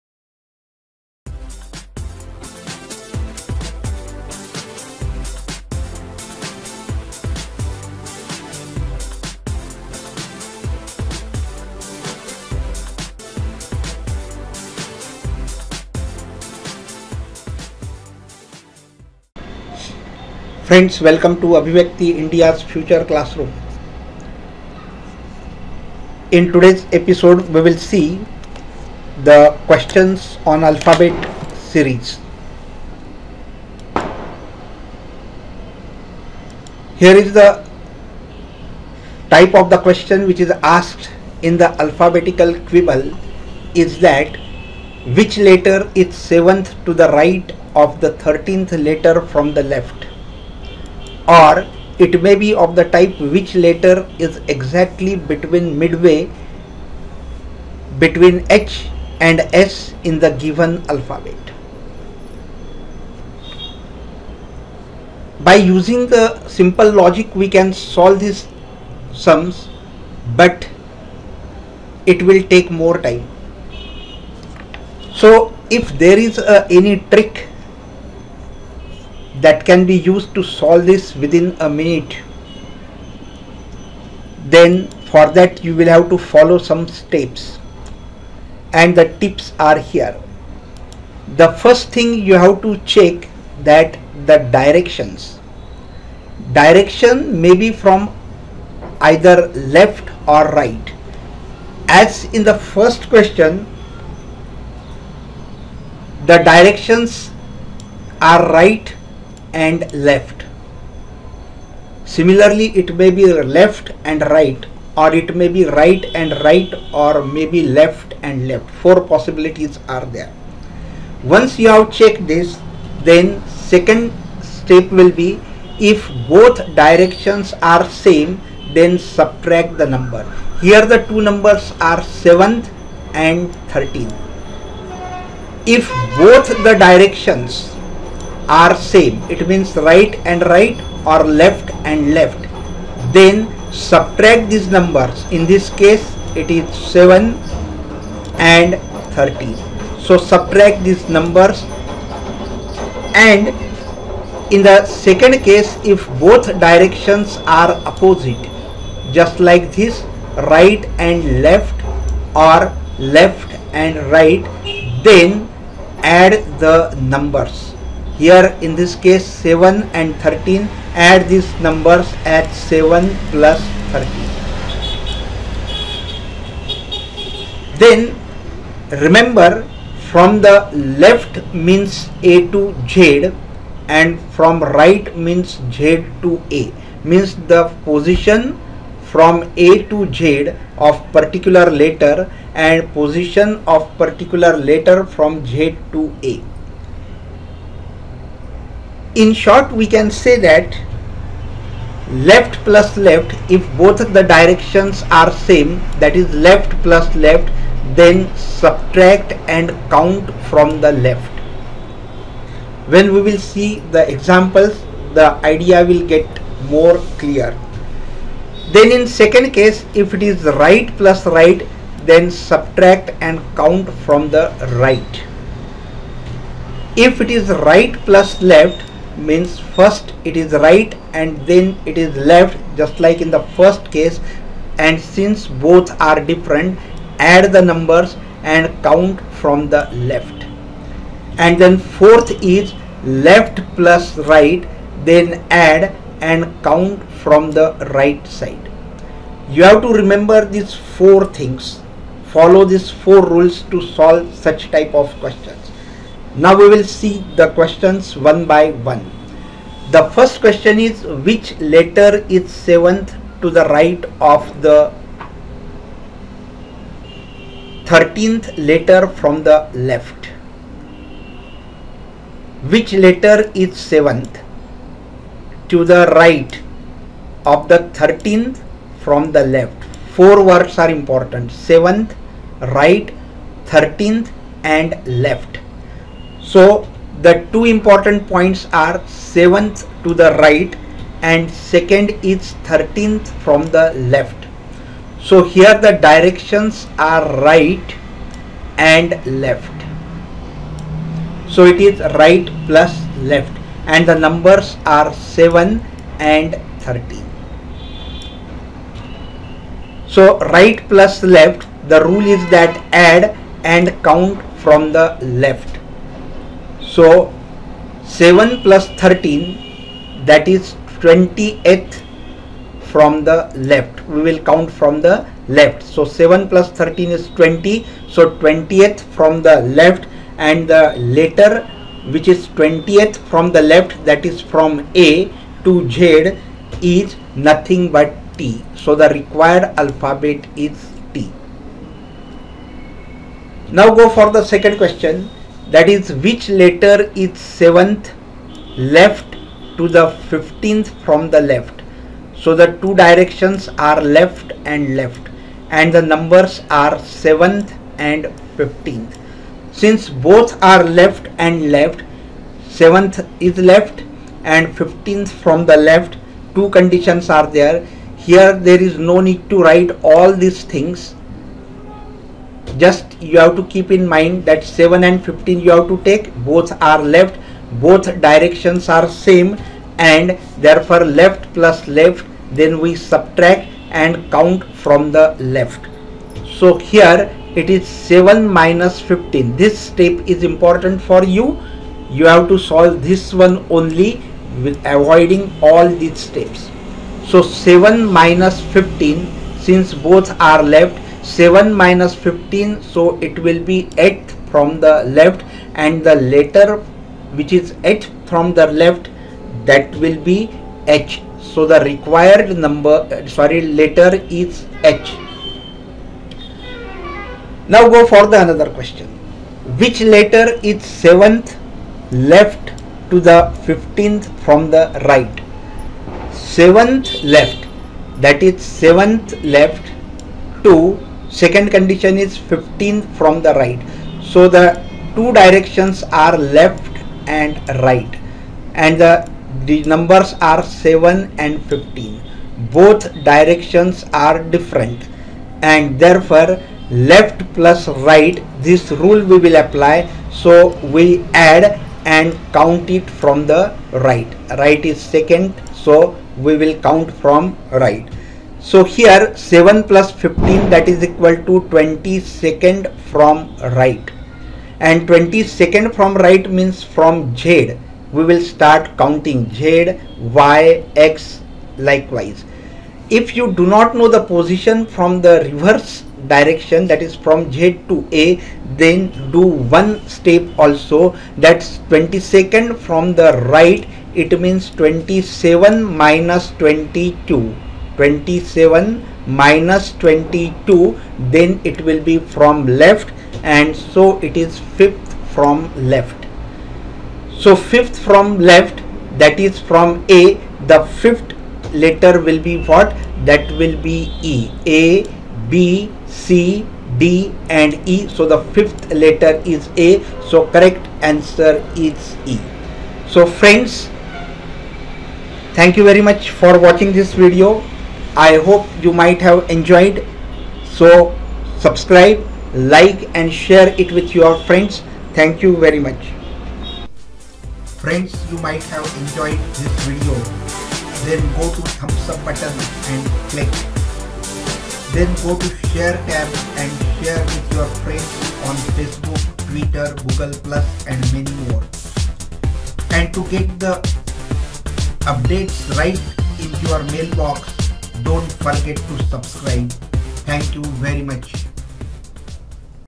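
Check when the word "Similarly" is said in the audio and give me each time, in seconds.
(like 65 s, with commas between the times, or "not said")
112 s.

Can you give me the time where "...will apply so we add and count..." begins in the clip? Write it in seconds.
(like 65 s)
449 s.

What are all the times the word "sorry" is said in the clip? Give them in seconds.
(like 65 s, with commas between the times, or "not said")
413 s.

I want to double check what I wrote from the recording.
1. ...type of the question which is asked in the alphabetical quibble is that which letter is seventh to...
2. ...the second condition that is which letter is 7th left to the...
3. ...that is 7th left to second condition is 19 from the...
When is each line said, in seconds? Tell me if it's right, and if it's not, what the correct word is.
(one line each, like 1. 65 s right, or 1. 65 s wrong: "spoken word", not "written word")
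1. 39 s right
2. 344 s wrong: "question", not "condition"
3. 428 s wrong: "15", not "19".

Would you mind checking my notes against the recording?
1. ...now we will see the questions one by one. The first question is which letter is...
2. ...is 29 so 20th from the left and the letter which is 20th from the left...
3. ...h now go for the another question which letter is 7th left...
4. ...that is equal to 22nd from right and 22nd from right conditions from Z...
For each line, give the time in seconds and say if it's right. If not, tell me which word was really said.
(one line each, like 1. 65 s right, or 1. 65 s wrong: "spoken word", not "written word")
1. 256 s right
2. 327 s wrong: "20", not "29"
3. 414 s right
4. 460 s wrong: "means", not "conditions".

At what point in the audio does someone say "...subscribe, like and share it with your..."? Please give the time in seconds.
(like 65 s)
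521 s.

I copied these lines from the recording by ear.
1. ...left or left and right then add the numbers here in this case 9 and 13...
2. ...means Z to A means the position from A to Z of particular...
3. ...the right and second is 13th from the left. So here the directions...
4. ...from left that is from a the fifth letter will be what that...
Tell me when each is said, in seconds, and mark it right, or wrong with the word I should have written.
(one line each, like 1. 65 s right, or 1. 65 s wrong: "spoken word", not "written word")
1. 161 s wrong: "7", not "9"
2. 185 s right
3. 290 s right
4. 497 s right.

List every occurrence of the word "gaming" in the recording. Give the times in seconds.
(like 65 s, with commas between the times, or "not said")
not said.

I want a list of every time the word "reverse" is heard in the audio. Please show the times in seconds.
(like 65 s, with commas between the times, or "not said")
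475 s.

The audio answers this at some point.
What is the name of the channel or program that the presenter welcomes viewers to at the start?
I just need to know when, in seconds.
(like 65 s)
22 s.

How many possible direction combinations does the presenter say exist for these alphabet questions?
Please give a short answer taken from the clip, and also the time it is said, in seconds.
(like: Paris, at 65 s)
4, at 118 s.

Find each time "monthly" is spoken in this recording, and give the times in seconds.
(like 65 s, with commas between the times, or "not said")
not said.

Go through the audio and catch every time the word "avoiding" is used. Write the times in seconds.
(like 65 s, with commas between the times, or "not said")
394 s.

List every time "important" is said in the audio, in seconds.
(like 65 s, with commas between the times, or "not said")
280 s, 287 s, 390 s.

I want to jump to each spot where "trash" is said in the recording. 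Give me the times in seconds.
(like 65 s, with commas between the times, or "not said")
not said.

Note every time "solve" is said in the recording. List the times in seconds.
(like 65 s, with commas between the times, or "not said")
67 s, 80 s, 253 s, 392 s.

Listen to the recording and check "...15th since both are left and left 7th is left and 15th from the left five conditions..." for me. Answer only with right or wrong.
wrong.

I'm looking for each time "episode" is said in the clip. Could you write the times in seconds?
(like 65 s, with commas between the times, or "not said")
26 s.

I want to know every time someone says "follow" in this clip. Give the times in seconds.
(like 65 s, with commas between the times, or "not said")
86 s, 252 s.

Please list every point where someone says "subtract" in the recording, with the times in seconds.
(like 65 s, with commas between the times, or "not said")
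128 s, 143 s, 150 s, 208 s, 222 s, 382 s.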